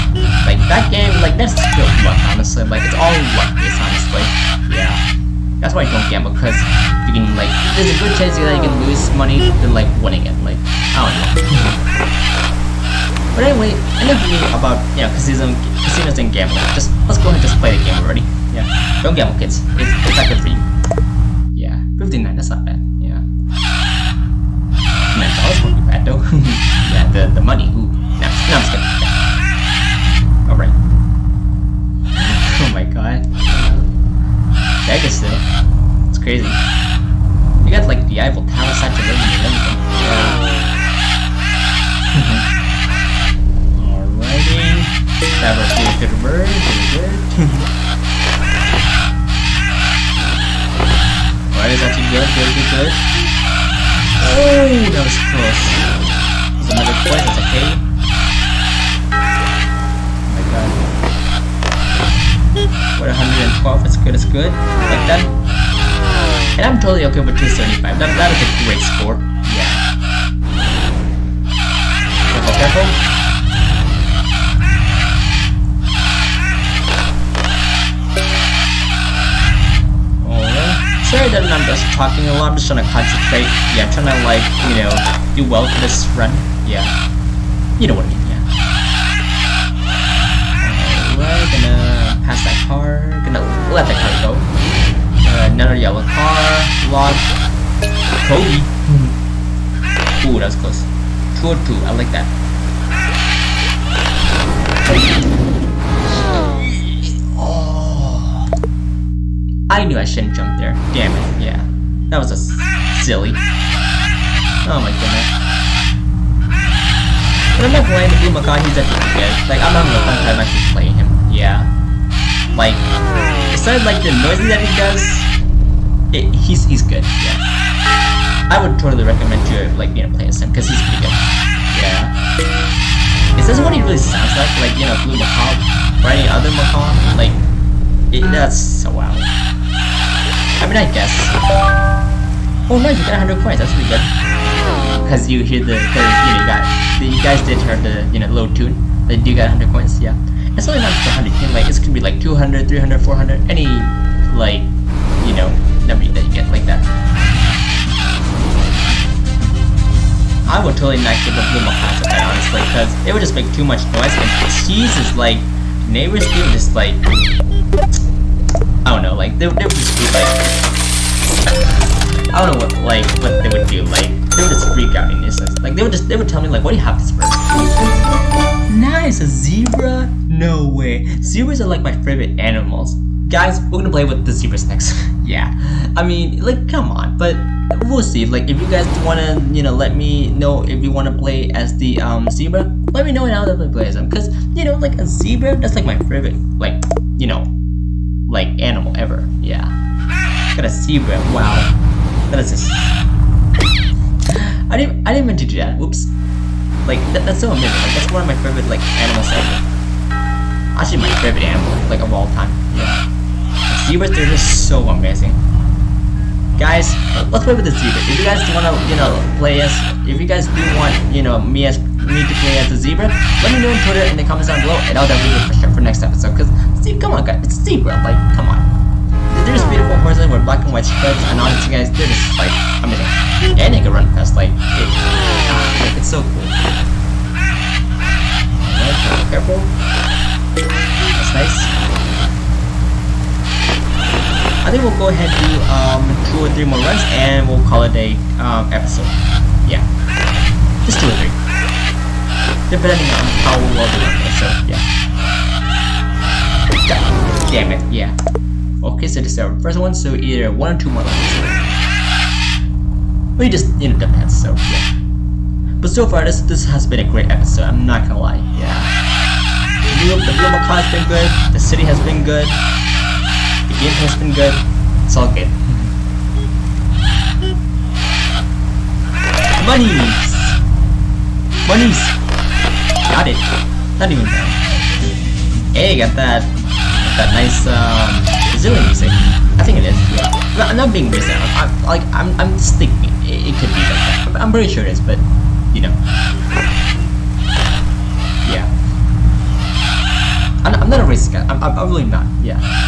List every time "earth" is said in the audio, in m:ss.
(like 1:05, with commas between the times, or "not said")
not said.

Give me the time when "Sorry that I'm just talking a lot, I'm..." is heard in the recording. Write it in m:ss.
1:21.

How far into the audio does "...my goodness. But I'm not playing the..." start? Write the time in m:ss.
1:54.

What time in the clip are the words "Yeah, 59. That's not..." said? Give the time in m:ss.
0:21.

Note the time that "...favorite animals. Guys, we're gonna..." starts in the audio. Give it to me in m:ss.
3:01.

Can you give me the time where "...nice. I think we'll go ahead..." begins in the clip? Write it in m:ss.
4:01.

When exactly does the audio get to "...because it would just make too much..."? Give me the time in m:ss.
2:42.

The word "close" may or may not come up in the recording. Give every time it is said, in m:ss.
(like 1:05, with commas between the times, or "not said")
0:55, 1:40.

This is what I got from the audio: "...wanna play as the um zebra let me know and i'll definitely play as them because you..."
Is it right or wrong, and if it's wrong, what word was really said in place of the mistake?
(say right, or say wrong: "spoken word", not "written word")
right.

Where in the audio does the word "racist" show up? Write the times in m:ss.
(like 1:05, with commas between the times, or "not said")
4:51, 5:01.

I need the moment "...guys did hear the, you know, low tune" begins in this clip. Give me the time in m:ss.
2:27.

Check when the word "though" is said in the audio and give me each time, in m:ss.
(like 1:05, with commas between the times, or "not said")
0:26, 0:35.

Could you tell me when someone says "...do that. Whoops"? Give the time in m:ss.
3:25.